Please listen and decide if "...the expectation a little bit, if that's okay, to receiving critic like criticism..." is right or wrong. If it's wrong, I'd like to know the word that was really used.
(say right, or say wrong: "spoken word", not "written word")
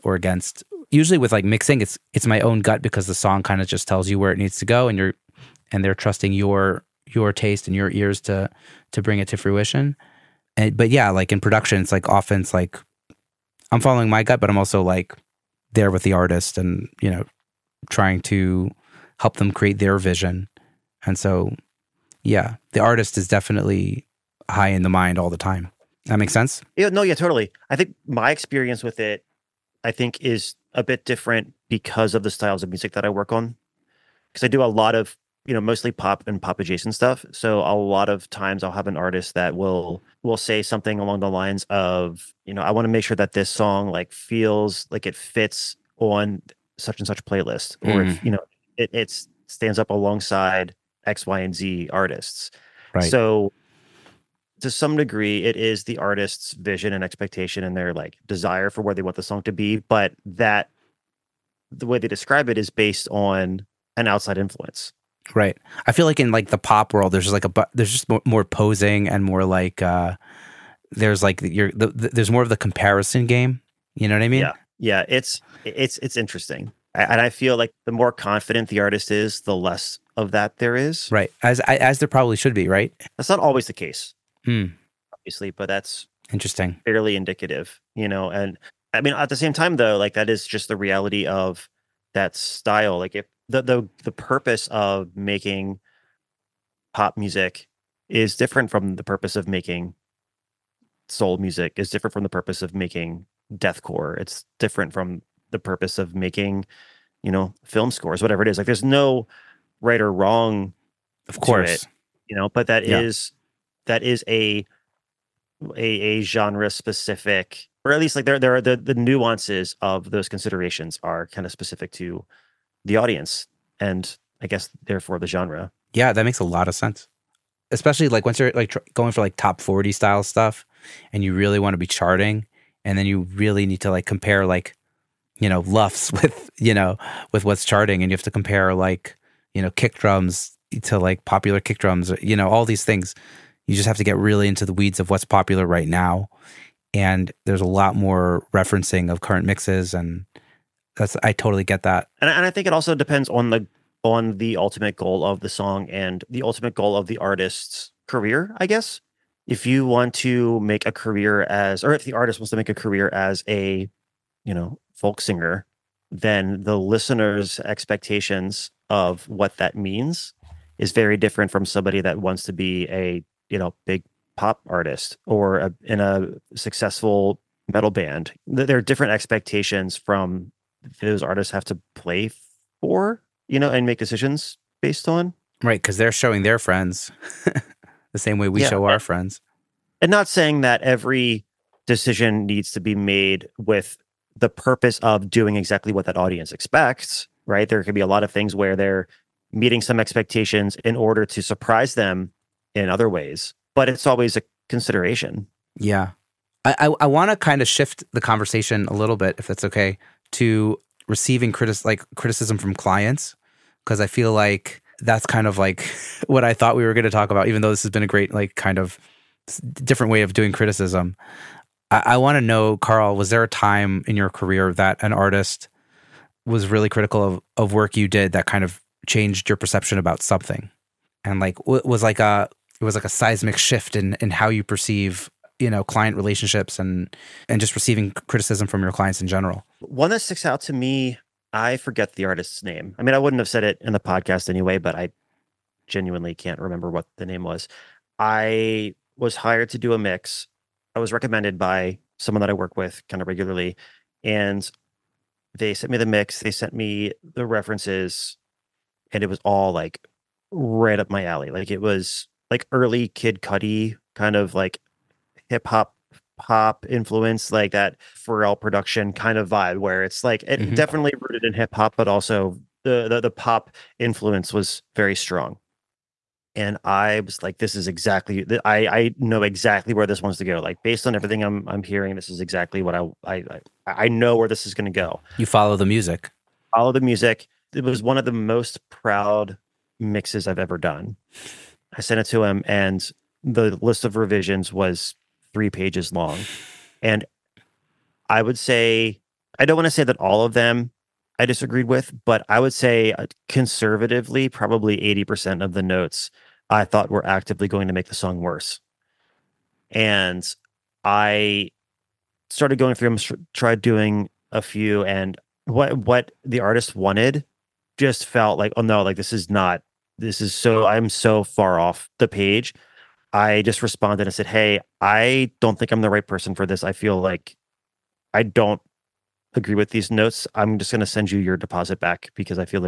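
wrong: "conversation", not "expectation".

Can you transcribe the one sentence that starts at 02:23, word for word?
You just have to get really into the weeds of what's popular right now.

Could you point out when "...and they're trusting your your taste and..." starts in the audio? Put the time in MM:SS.
00:05.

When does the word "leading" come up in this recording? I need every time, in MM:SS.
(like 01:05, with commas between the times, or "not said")
not said.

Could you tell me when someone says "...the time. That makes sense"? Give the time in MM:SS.
00:25.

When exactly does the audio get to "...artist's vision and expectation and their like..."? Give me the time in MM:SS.
00:55.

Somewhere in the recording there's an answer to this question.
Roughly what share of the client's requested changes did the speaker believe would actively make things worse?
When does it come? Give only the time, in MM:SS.
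05:04.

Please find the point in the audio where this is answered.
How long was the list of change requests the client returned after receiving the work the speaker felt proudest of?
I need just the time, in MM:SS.
04:55.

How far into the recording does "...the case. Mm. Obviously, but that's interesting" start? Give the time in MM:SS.
01:23.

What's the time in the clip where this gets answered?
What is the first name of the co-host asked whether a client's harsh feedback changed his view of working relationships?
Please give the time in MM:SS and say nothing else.
03:42.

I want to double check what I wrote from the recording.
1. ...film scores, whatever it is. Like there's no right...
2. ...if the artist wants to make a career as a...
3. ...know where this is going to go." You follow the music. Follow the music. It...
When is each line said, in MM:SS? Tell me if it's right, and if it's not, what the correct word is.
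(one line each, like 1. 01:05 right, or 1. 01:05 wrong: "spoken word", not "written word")
1. 01:47 right
2. 02:41 right
3. 04:44 right.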